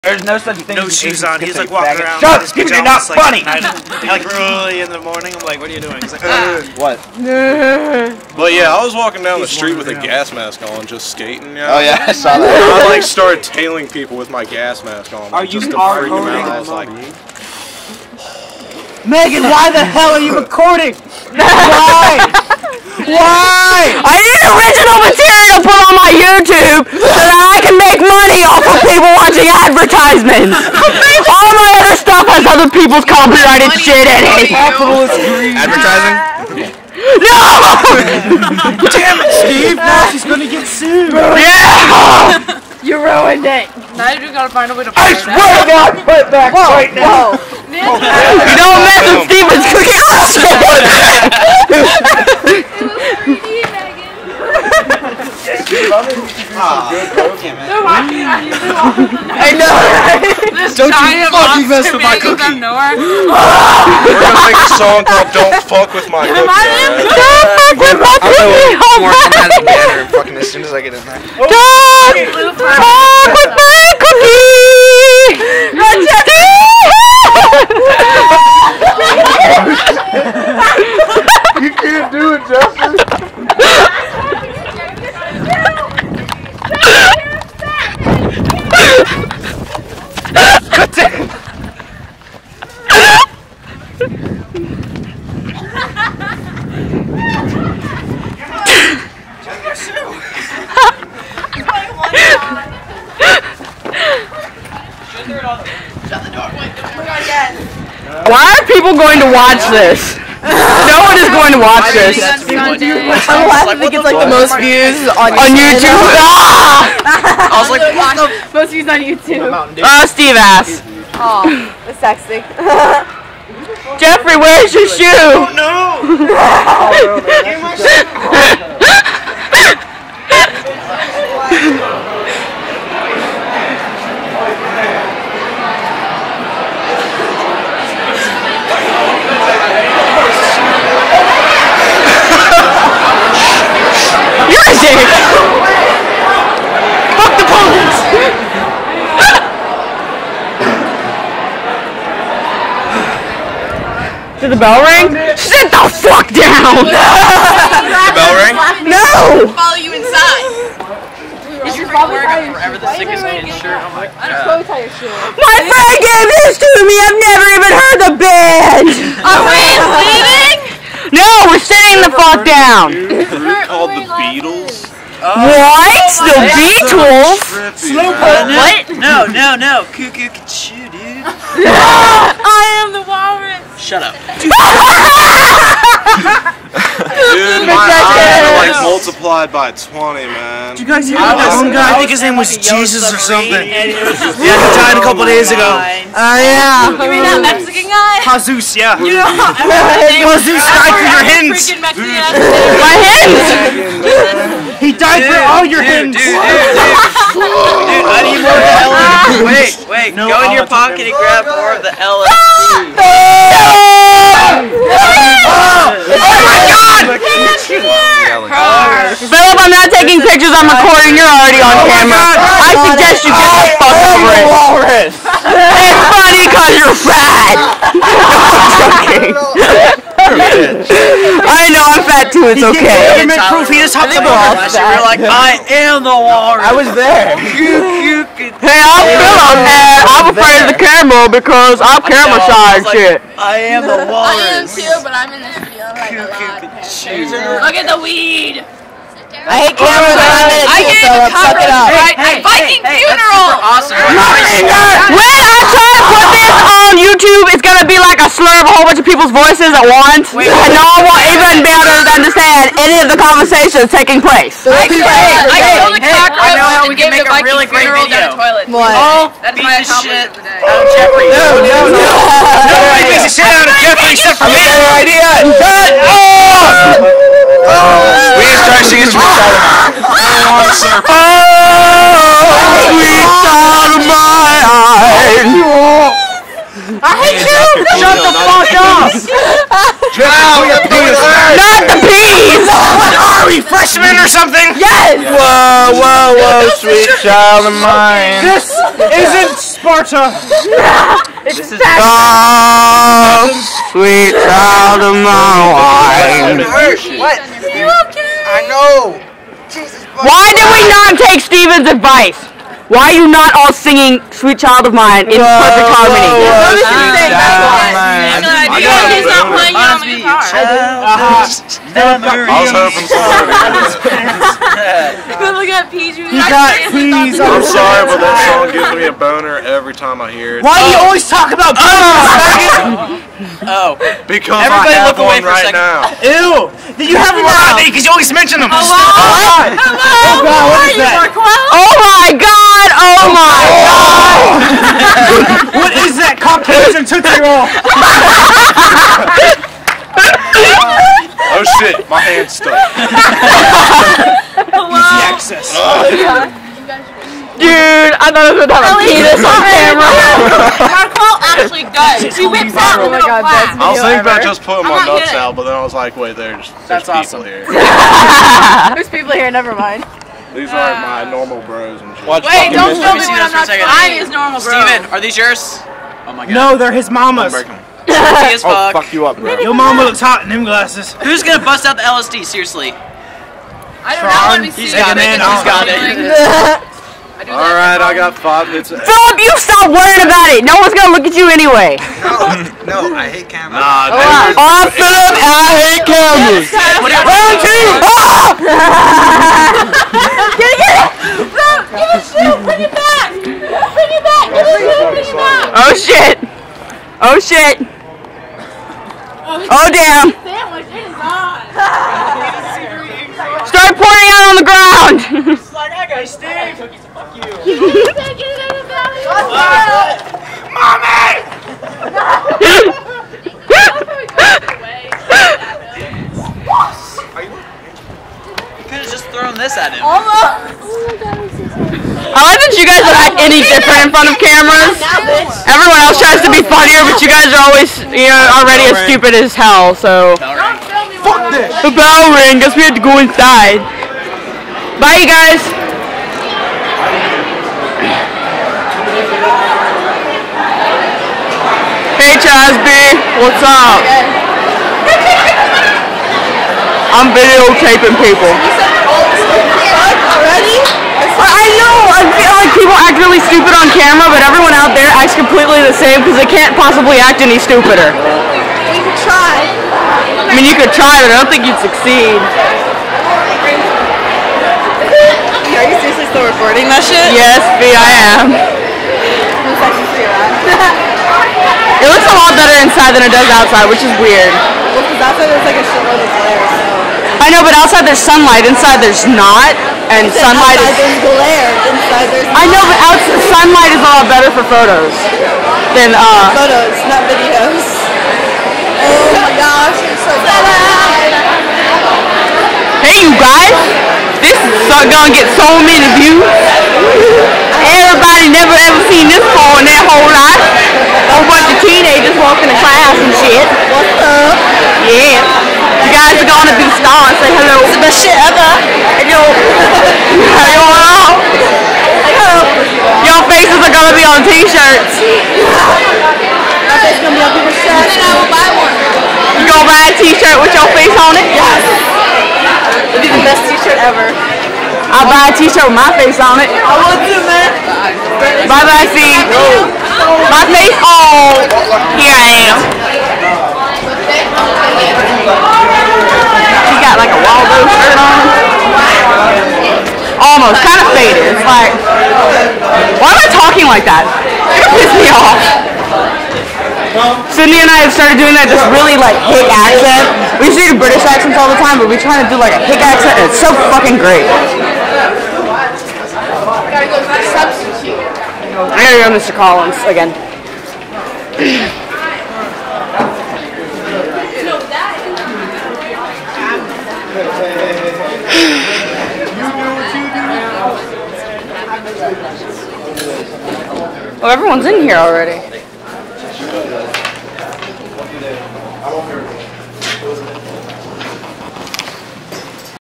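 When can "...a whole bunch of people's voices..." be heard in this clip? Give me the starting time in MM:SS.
04:18.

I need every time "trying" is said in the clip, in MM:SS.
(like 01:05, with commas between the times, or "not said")
06:13, 09:22.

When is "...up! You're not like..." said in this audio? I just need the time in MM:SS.
00:02.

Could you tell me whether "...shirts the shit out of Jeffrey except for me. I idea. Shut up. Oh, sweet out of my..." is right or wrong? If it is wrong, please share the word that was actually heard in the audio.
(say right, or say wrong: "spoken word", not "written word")
wrong: "beats", not "shirts".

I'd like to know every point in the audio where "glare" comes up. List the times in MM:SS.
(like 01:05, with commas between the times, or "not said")
08:06, 08:11.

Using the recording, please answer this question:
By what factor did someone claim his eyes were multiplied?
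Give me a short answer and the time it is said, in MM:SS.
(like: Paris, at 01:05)
20, at 03:09.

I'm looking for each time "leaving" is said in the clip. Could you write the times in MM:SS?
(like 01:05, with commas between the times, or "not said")
02:50.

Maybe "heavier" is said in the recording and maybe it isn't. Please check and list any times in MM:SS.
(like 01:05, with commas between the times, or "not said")
not said.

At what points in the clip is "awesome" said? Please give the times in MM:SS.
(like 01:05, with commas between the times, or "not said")
04:13, 06:07.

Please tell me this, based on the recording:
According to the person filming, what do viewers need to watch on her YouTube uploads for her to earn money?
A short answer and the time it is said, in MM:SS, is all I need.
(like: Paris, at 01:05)
advertisements, at 00:29.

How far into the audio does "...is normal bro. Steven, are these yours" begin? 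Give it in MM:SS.
06:14.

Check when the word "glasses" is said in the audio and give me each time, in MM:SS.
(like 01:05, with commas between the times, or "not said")
06:20.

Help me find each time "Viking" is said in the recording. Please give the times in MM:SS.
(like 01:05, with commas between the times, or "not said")
04:12, 04:27.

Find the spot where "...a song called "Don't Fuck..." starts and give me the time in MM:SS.
01:04.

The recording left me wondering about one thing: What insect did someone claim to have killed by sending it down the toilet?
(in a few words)
cockroach.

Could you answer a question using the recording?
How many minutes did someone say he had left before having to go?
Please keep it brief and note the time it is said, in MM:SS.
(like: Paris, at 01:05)
5, at 06:28.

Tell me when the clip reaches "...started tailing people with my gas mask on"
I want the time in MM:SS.
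00:13.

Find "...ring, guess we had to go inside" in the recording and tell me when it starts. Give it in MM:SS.
07:22.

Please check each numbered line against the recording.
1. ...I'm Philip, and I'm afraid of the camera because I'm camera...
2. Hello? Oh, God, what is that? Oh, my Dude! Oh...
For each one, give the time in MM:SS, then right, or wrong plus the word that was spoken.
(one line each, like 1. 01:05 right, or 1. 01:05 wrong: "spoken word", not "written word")
1. 03:58 right
2. 05:38 wrong: "God", not "Dude".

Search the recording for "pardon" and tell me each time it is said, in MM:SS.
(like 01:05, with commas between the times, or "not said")
not said.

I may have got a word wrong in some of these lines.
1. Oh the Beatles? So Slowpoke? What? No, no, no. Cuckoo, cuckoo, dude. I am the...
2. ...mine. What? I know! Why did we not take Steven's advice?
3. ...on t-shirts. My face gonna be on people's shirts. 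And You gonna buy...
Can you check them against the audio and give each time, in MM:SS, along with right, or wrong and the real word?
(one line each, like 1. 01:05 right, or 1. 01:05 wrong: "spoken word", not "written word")
1. 02:56 right
2. 05:05 right
3. 08:44 right.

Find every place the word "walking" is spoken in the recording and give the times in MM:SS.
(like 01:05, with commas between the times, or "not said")
00:01, 00:08, 08:32.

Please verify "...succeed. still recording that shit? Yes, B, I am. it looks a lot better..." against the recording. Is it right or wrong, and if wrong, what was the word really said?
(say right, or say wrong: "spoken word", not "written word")
right.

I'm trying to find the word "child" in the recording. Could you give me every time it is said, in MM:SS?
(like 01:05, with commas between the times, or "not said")
04:57, 05:04, 05:14.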